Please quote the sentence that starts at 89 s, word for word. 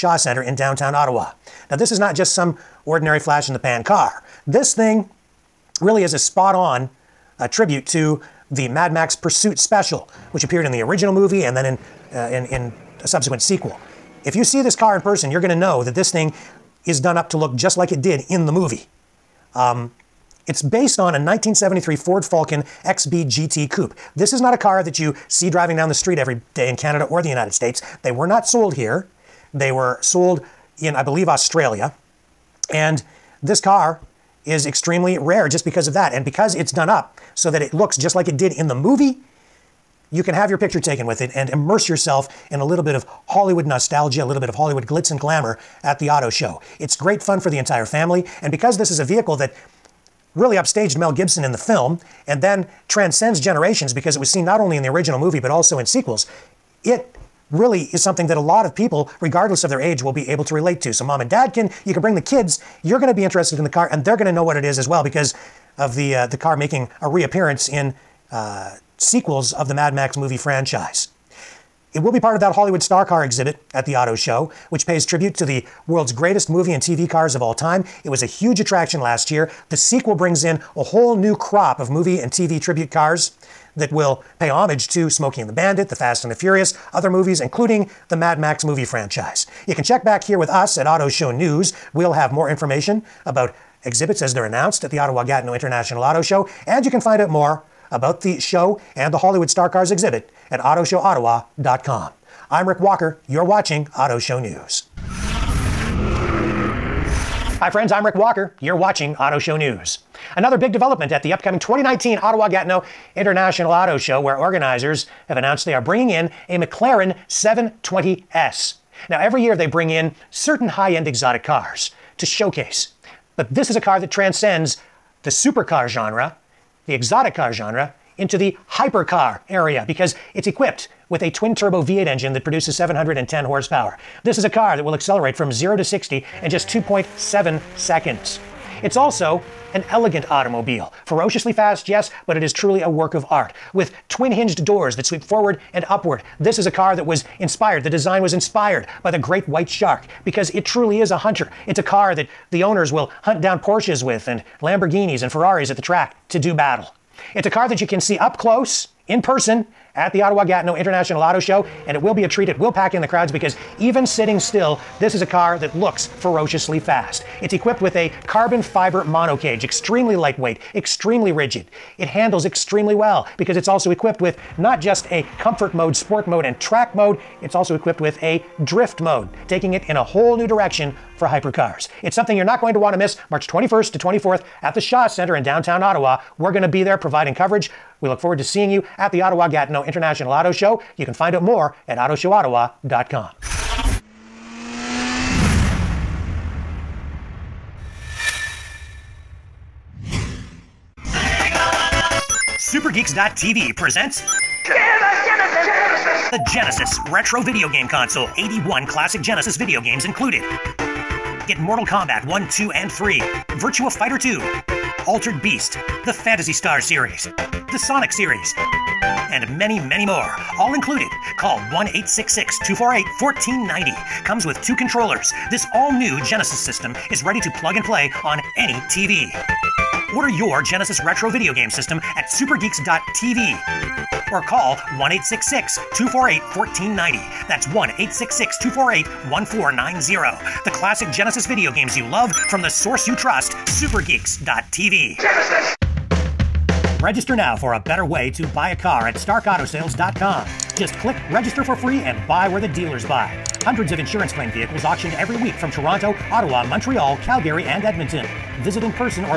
You can check back here with us at Auto Show News.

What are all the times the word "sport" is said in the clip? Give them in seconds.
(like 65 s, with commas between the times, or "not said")
175 s.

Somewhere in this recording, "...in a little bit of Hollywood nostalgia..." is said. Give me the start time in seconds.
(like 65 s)
42 s.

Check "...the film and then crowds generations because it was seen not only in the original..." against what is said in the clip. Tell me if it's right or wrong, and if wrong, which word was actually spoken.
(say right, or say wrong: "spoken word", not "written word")
wrong: "transcends", not "crowds".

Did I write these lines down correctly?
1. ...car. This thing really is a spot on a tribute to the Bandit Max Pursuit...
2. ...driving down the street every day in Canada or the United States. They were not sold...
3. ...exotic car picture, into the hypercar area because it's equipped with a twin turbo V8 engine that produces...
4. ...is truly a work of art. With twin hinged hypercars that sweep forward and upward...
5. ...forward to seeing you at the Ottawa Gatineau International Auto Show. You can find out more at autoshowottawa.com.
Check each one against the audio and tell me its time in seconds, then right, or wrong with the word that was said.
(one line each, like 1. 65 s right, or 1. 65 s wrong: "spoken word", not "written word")
1. 3 s wrong: "Mad", not "Bandit"
2. 25 s right
3. 126 s wrong: "genre", not "picture"
4. 142 s wrong: "doors", not "hypercars"
5. 188 s right.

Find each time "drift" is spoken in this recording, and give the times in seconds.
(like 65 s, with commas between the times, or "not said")
178 s.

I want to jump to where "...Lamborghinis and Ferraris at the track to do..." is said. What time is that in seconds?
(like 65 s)
154 s.